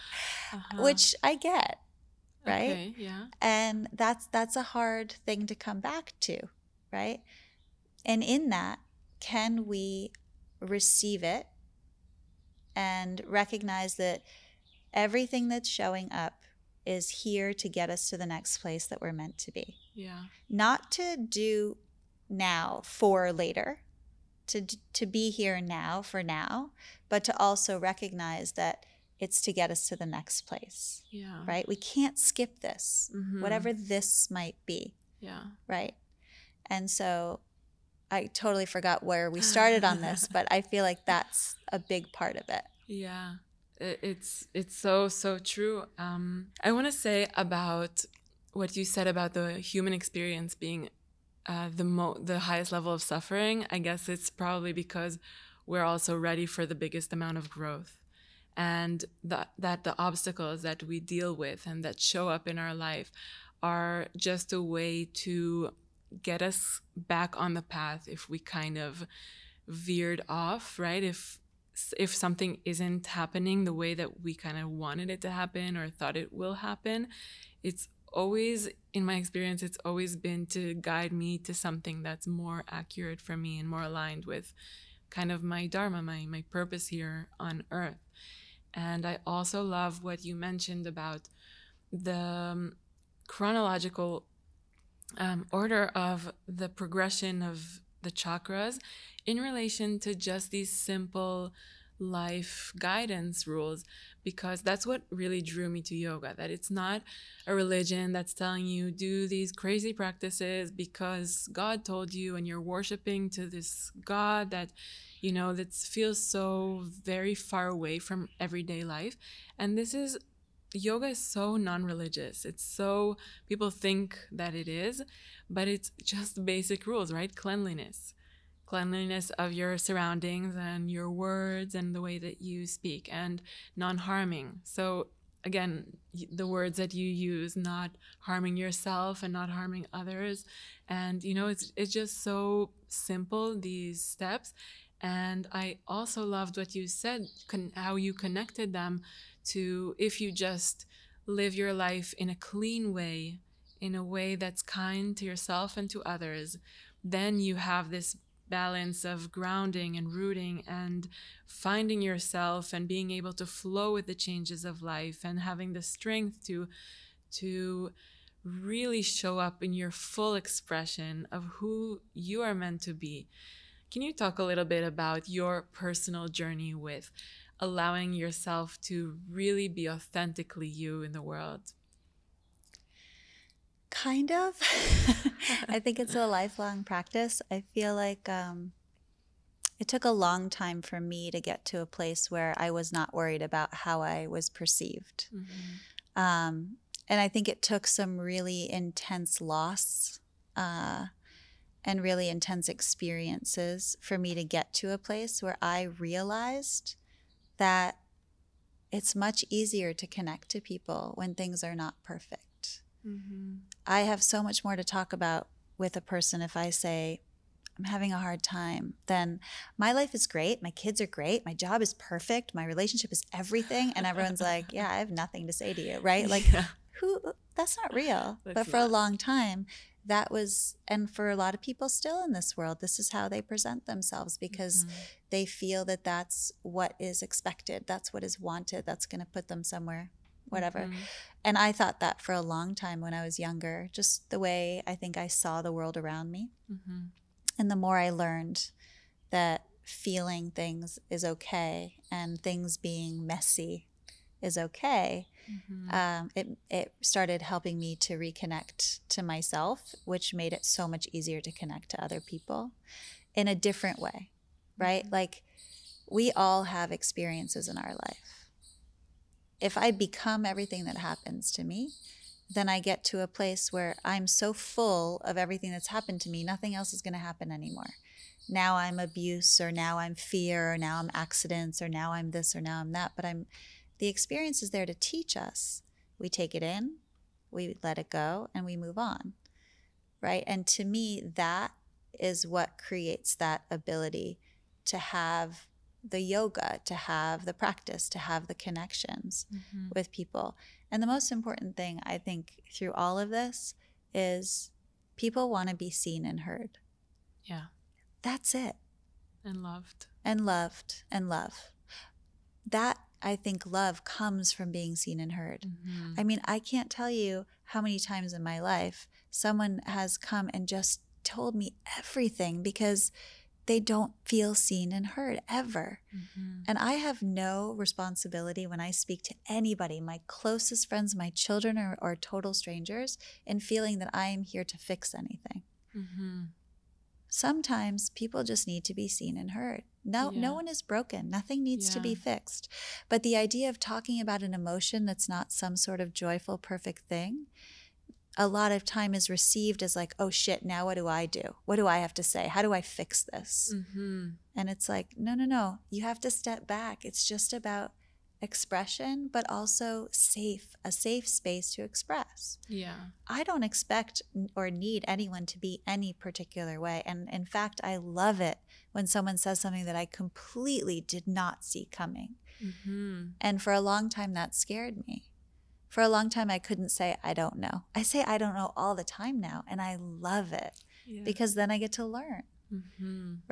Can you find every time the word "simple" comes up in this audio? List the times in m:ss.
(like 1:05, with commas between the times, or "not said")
1:40, 2:22.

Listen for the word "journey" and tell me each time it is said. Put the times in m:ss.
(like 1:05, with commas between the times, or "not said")
2:56.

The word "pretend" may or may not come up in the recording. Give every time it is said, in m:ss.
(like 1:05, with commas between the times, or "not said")
not said.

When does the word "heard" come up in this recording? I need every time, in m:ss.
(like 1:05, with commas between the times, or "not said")
5:06, 5:15, 5:25, 5:39.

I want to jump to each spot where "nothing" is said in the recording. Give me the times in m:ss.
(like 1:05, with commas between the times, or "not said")
3:45, 4:36, 5:41.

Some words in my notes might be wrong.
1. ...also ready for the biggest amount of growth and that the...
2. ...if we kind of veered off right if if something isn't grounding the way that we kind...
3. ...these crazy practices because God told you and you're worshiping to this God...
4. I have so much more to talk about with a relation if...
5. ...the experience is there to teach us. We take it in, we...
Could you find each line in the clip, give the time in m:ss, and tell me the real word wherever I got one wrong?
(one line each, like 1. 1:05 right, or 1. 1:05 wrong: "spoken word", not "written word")
1. 0:55 right
2. 1:08 wrong: "happening", not "grounding"
3. 1:49 right
4. 3:33 wrong: "person", not "relation"
5. 4:44 right.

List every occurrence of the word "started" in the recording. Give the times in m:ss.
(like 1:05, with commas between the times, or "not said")
0:39, 4:17.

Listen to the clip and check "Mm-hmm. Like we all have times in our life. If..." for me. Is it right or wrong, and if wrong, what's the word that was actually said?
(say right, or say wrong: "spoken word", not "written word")
wrong: "experiences", not "times".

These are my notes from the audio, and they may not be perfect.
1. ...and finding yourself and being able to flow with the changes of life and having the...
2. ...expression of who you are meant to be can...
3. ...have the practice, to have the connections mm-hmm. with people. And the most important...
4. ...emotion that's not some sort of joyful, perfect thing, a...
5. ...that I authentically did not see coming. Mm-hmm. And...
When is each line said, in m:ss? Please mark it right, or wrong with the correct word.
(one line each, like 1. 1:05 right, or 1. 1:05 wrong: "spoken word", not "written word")
1. 2:40 right
2. 2:50 right
3. 4:56 right
4. 5:44 right
5. 6:09 wrong: "completely", not "authentically".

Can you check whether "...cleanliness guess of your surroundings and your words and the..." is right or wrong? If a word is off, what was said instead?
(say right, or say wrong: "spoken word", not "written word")
wrong: "cleanliness", not "guess".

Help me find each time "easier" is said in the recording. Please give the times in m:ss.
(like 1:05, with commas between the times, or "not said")
3:29, 4:21.